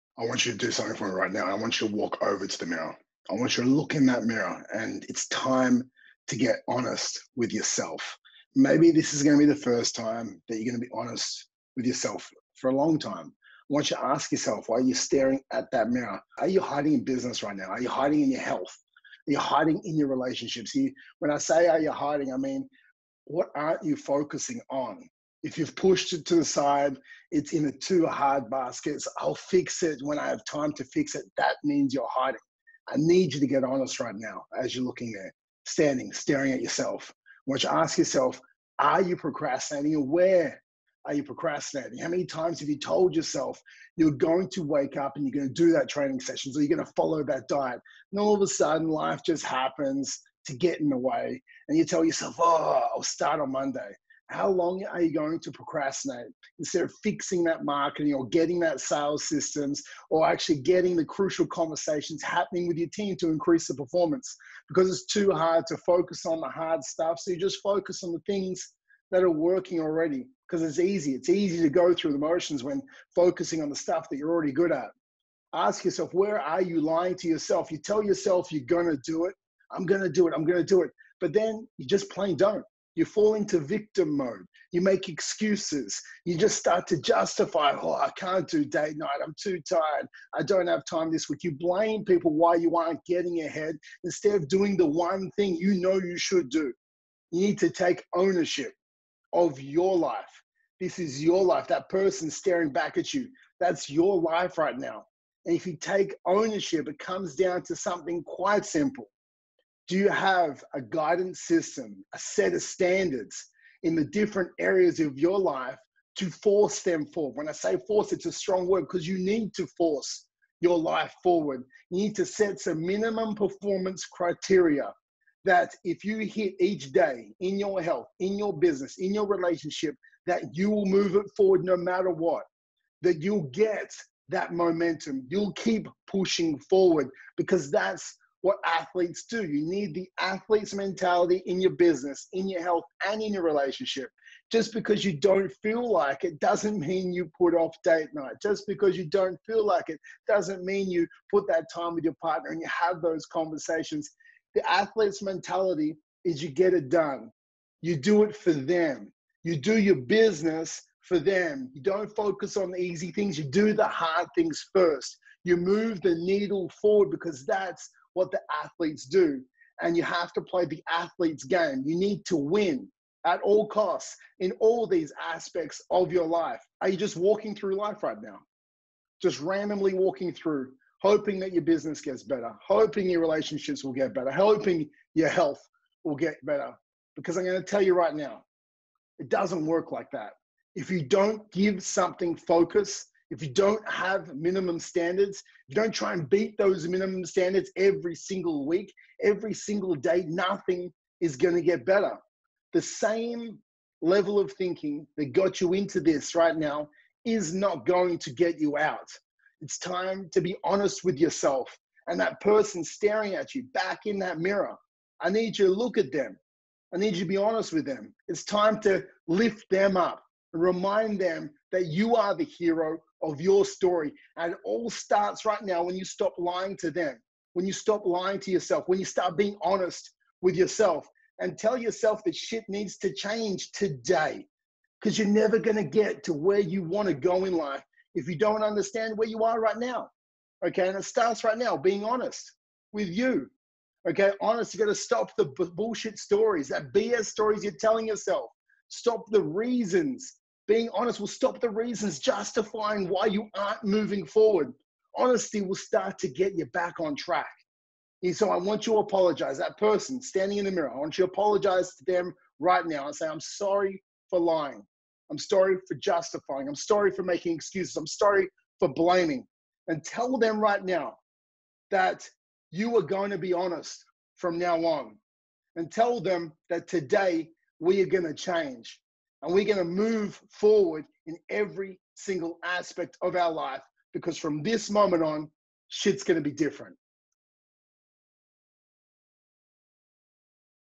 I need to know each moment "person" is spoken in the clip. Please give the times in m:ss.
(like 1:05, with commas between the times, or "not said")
1:41, 3:32, 4:19.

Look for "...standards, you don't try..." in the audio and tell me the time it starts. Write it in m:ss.
3:14.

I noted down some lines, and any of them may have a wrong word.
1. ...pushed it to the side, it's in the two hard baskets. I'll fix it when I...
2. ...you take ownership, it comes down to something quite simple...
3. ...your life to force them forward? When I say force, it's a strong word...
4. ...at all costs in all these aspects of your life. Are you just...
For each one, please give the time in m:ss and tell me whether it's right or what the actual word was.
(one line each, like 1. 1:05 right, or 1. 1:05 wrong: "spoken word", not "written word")
1. 0:25 right
2. 1:45 right
3. 1:55 right
4. 2:53 right.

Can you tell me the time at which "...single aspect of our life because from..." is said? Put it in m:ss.
4:42.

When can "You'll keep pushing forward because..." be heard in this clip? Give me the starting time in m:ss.
2:15.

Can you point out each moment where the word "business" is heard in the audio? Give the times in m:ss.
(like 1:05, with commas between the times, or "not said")
0:17, 2:08, 2:21, 2:39, 3:01.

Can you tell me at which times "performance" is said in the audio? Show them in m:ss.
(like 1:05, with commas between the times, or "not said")
1:03, 2:03.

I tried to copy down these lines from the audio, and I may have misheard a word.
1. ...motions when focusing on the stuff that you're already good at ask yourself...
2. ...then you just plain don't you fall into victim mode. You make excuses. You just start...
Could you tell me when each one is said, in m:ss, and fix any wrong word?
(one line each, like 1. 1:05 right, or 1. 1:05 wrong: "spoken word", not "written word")
1. 1:12 right
2. 1:21 right.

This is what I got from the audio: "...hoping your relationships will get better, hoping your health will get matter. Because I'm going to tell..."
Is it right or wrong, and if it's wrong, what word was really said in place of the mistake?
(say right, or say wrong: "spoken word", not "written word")
wrong: "better", not "matter".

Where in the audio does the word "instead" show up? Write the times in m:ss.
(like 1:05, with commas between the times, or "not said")
0:56, 1:34.